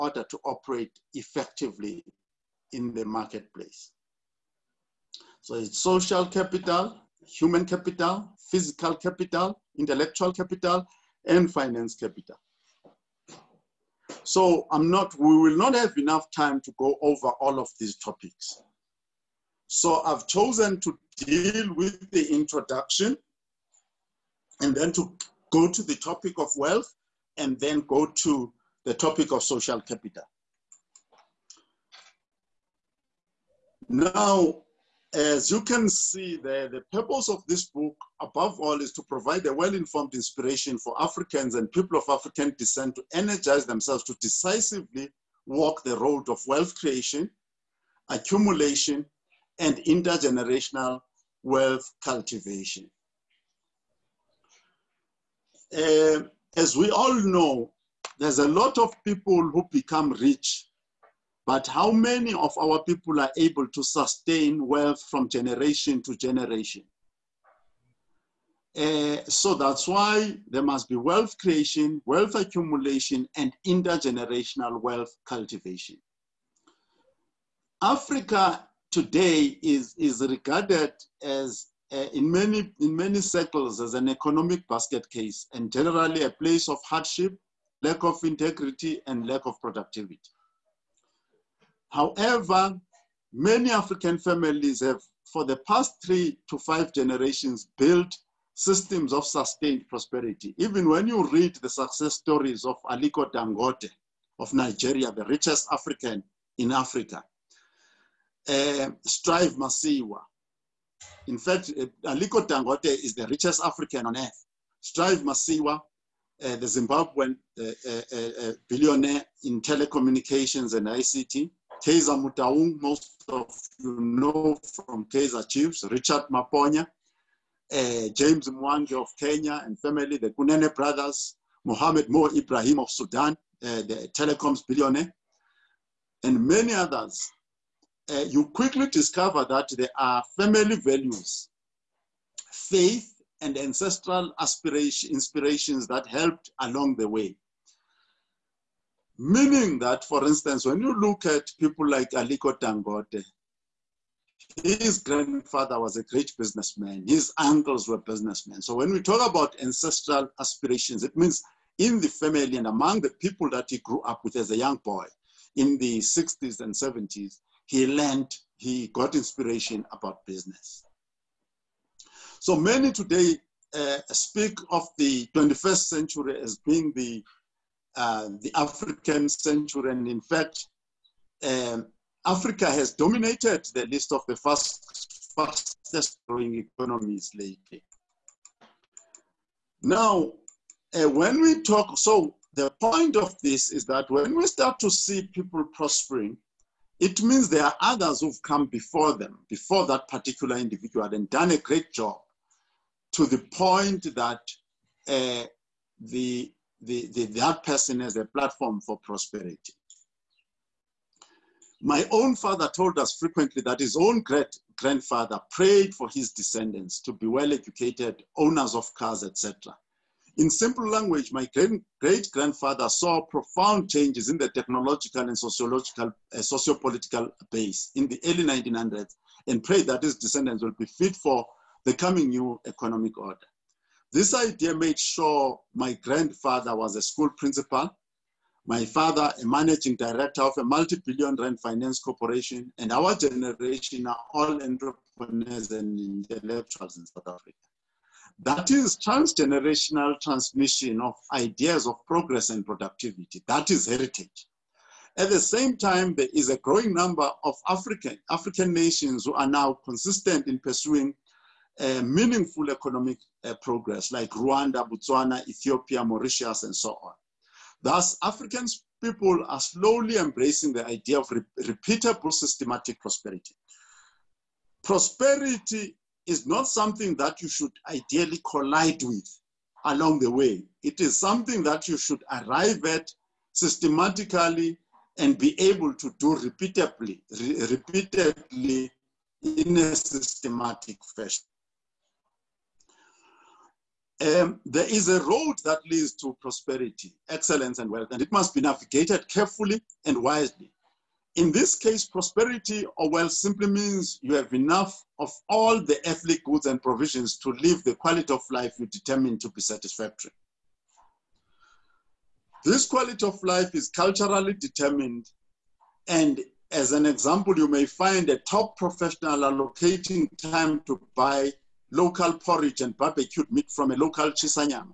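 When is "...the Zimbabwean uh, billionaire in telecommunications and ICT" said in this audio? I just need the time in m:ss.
1:56.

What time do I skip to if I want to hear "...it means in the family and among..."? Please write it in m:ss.
2:41.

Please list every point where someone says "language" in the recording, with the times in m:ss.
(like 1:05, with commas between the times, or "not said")
3:40.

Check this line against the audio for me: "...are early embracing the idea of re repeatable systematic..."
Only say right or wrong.
wrong.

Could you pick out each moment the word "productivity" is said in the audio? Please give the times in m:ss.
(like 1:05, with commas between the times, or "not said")
1:29, 4:12.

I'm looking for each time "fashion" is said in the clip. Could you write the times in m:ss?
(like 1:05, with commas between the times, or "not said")
4:51.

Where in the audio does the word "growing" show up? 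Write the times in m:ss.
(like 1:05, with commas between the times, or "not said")
3:06, 4:16.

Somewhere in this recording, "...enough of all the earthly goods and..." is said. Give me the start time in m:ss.
5:04.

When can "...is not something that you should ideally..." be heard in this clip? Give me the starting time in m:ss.
4:36.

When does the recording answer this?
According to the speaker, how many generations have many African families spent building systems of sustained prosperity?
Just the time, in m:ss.
1:36.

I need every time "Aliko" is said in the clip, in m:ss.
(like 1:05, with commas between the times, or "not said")
1:42, 1:52, 2:32.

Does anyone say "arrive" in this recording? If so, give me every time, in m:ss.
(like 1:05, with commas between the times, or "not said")
4:42.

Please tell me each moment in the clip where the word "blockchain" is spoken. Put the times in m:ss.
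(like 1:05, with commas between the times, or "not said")
not said.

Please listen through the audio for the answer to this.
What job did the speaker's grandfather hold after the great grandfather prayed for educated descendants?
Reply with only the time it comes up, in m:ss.
3:57.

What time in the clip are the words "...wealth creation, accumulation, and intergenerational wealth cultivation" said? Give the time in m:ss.
0:46.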